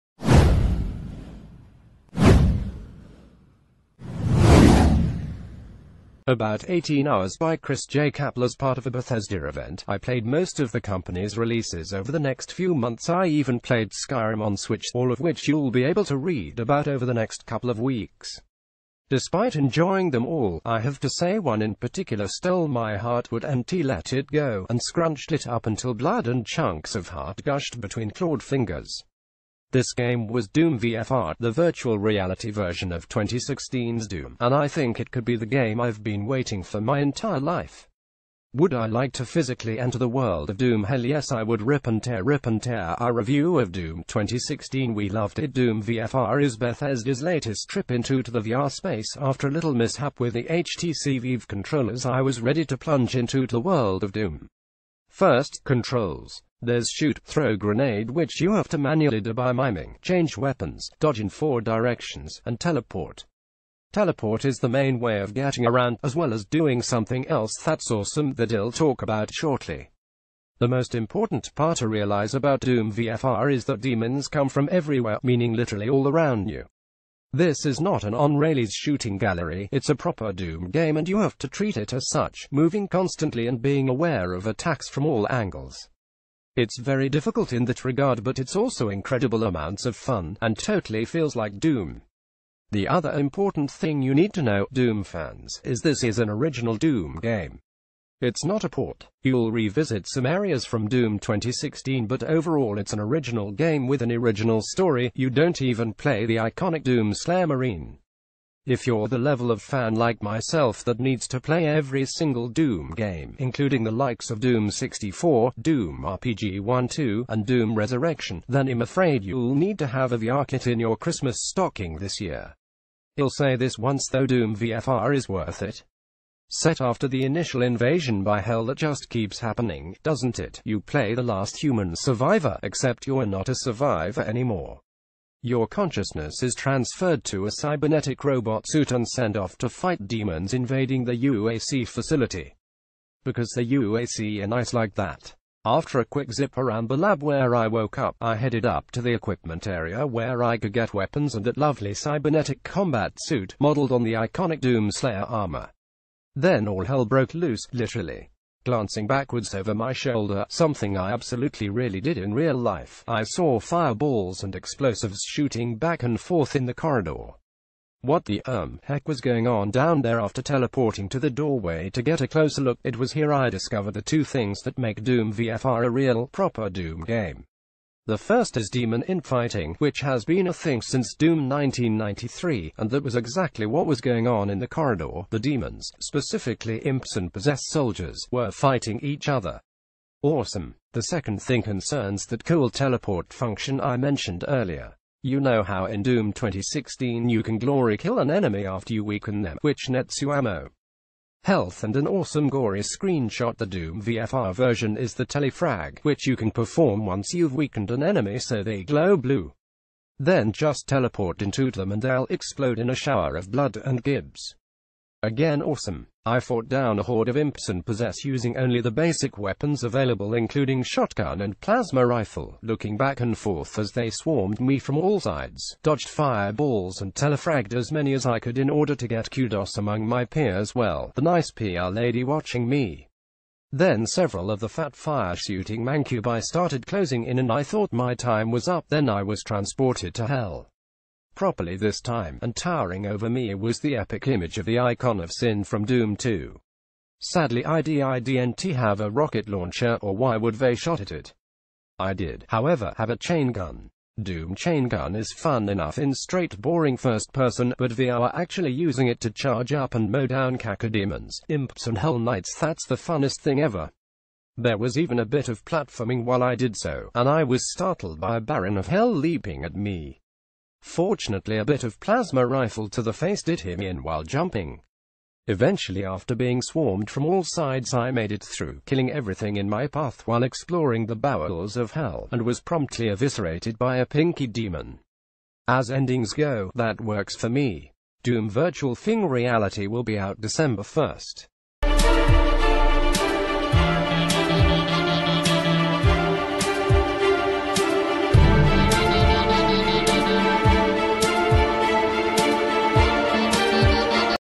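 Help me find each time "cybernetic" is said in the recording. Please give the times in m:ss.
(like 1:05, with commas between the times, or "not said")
2:17, 2:31.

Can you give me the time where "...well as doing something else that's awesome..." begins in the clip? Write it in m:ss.
1:06.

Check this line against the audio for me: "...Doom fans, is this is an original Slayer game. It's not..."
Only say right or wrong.
wrong.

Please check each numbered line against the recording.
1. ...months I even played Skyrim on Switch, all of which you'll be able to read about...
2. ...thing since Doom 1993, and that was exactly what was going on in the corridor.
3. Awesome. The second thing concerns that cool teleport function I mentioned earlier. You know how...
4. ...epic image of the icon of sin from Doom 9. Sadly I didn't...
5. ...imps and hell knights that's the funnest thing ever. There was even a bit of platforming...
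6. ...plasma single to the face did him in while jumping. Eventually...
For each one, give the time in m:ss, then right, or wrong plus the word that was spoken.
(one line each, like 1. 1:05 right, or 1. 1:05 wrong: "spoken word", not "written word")
1. 0:12 right
2. 3:00 right
3. 3:10 right
4. 4:03 wrong: "2", not "9"
5. 4:21 right
6. 4:31 wrong: "rifle", not "single".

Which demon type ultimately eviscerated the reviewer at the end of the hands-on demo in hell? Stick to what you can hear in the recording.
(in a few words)
pinky demon.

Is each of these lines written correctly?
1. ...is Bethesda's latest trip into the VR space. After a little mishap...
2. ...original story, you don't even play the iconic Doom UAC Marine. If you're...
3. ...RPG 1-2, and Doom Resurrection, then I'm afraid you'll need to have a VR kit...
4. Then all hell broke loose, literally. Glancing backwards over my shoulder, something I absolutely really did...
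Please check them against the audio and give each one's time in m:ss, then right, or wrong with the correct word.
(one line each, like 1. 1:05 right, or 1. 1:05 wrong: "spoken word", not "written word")
1. 0:46 right
2. 1:44 wrong: "Slayer", not "UAC"
3. 1:56 right
4. 2:36 right.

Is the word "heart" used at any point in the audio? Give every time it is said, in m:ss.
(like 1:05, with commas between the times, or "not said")
0:22, 0:27.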